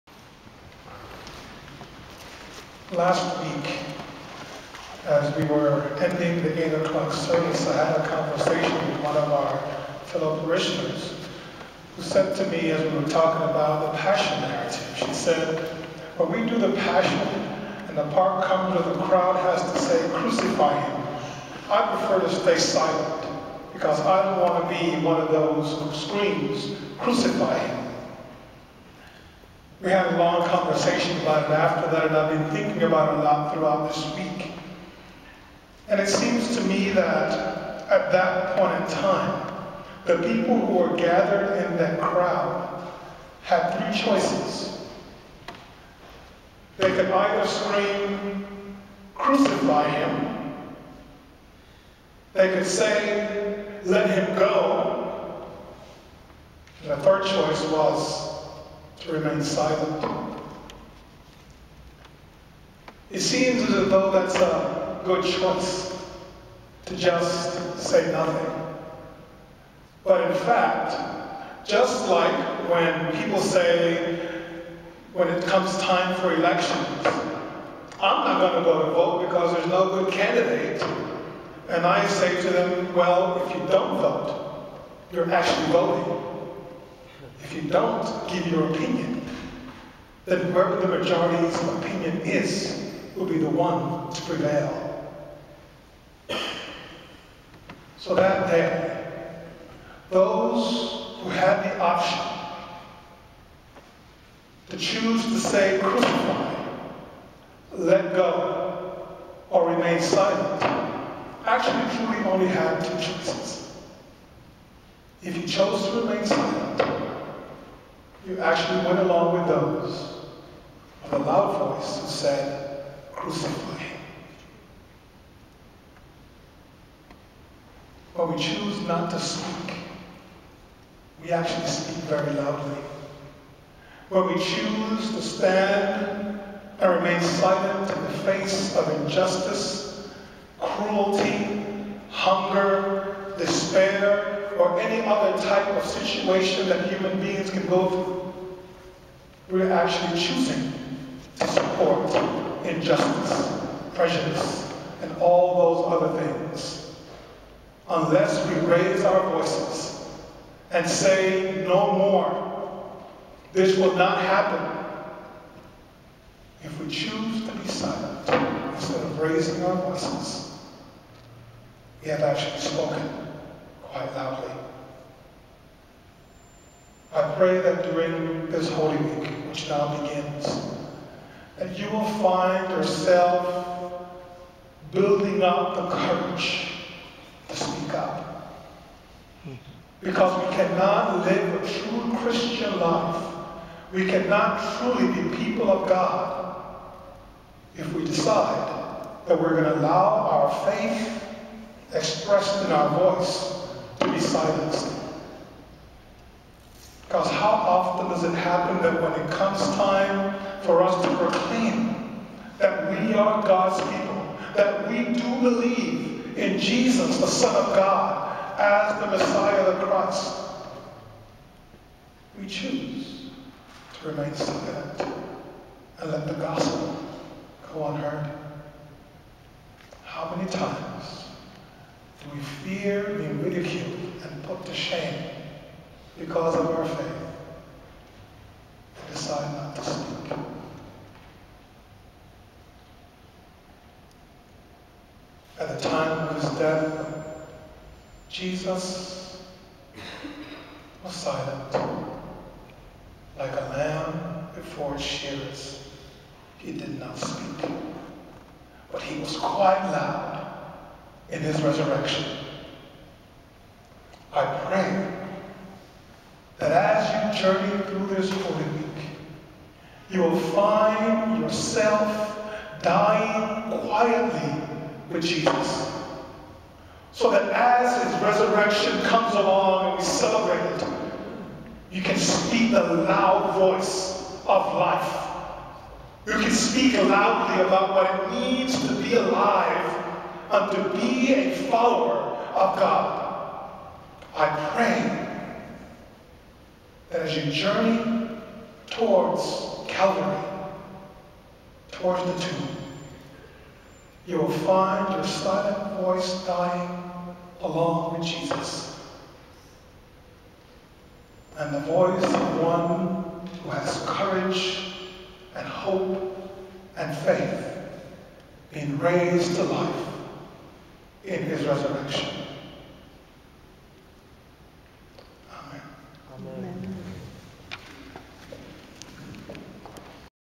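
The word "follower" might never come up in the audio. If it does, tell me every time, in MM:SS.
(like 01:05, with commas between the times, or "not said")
04:51.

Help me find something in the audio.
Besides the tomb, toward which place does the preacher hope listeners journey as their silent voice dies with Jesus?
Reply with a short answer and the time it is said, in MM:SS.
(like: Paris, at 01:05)
Calvary, at 04:59.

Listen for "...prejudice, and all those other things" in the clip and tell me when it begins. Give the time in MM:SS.
02:33.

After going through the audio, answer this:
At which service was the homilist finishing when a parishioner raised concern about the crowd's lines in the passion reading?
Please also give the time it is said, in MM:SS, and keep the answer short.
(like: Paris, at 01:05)
8 o'clock service, at 00:06.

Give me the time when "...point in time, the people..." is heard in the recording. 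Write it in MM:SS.
00:38.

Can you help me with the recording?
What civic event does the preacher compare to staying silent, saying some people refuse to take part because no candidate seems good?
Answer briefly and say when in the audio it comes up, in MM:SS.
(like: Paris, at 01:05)
Elections, at 01:16.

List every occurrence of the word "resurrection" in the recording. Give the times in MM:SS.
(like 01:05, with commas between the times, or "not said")
04:21, 04:38, 05:21.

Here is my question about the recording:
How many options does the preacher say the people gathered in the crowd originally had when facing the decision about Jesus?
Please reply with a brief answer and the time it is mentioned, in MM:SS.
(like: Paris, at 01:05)
3, at 00:43.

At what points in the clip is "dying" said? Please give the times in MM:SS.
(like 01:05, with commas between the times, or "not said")
04:32, 05:06.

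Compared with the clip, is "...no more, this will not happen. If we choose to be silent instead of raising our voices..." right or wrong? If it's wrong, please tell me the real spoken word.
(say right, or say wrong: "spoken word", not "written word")
right.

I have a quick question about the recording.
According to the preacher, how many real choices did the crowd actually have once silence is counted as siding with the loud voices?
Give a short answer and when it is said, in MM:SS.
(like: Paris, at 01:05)
2, at 01:52.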